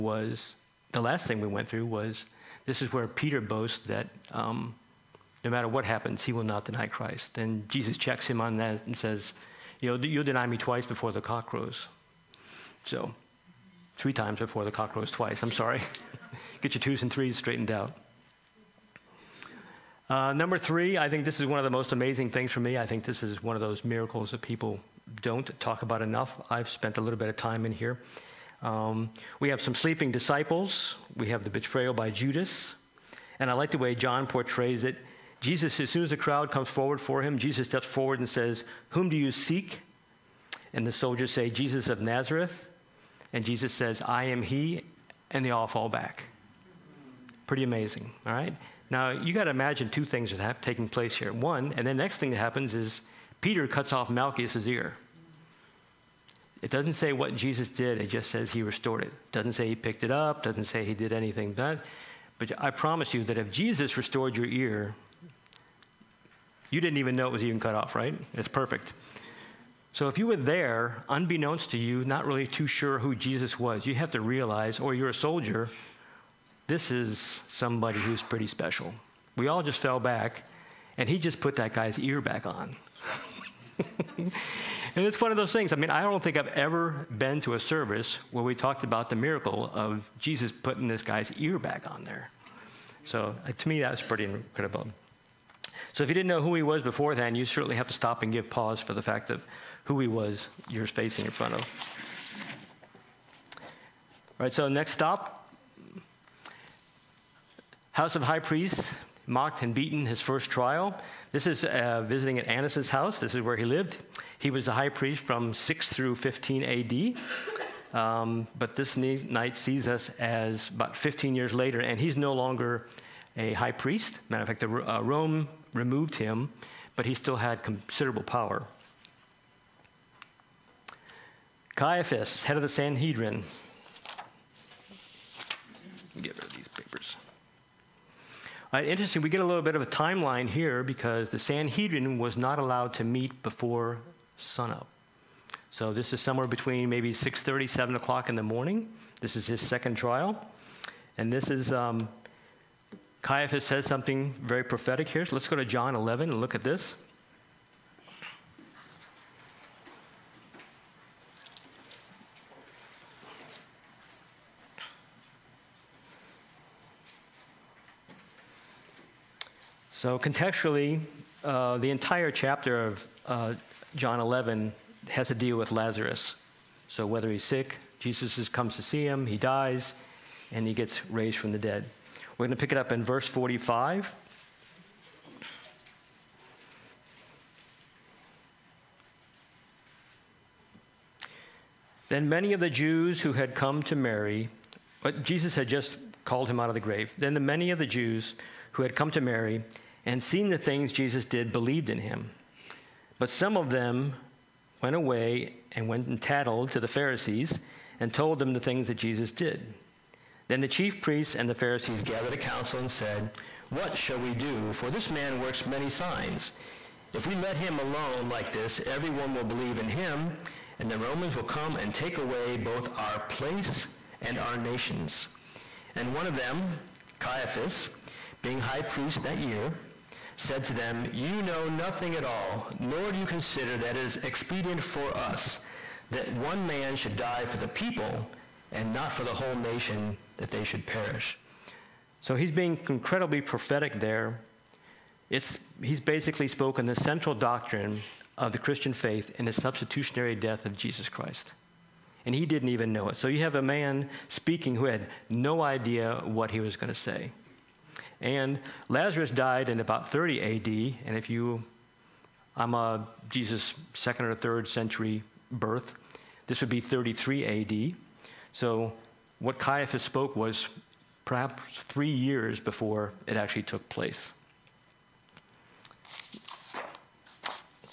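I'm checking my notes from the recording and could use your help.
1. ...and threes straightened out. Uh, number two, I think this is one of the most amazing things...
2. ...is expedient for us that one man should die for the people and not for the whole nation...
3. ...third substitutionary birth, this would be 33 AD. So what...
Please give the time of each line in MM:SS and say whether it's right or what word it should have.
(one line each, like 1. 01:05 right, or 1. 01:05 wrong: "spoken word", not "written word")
1. 00:17 wrong: "three", not "two"
2. 03:54 right
3. 04:24 wrong: "century", not "substitutionary".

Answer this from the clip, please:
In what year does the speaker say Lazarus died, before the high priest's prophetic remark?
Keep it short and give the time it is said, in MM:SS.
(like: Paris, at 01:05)
30 AD, at 04:20.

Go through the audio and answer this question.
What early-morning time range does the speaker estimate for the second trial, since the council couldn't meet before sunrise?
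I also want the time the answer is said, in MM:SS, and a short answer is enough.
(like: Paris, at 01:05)
6:30 to 7 o'clock, at 02:27.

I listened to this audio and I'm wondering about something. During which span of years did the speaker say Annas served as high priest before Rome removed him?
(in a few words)
6 through 15 AD.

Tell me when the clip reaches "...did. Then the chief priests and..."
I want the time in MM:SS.
03:29.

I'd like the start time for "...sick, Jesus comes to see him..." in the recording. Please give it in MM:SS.
02:57.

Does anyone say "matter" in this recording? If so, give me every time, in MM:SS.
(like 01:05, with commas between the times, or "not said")
00:05, 02:04.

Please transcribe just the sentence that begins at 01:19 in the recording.
We all just fell back, and he just put that guy's ear back on.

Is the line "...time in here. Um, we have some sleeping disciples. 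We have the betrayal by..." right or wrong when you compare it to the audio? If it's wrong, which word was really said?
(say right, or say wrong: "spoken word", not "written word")
right.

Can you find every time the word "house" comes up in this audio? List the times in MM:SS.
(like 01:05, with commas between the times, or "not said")
01:47, 01:52.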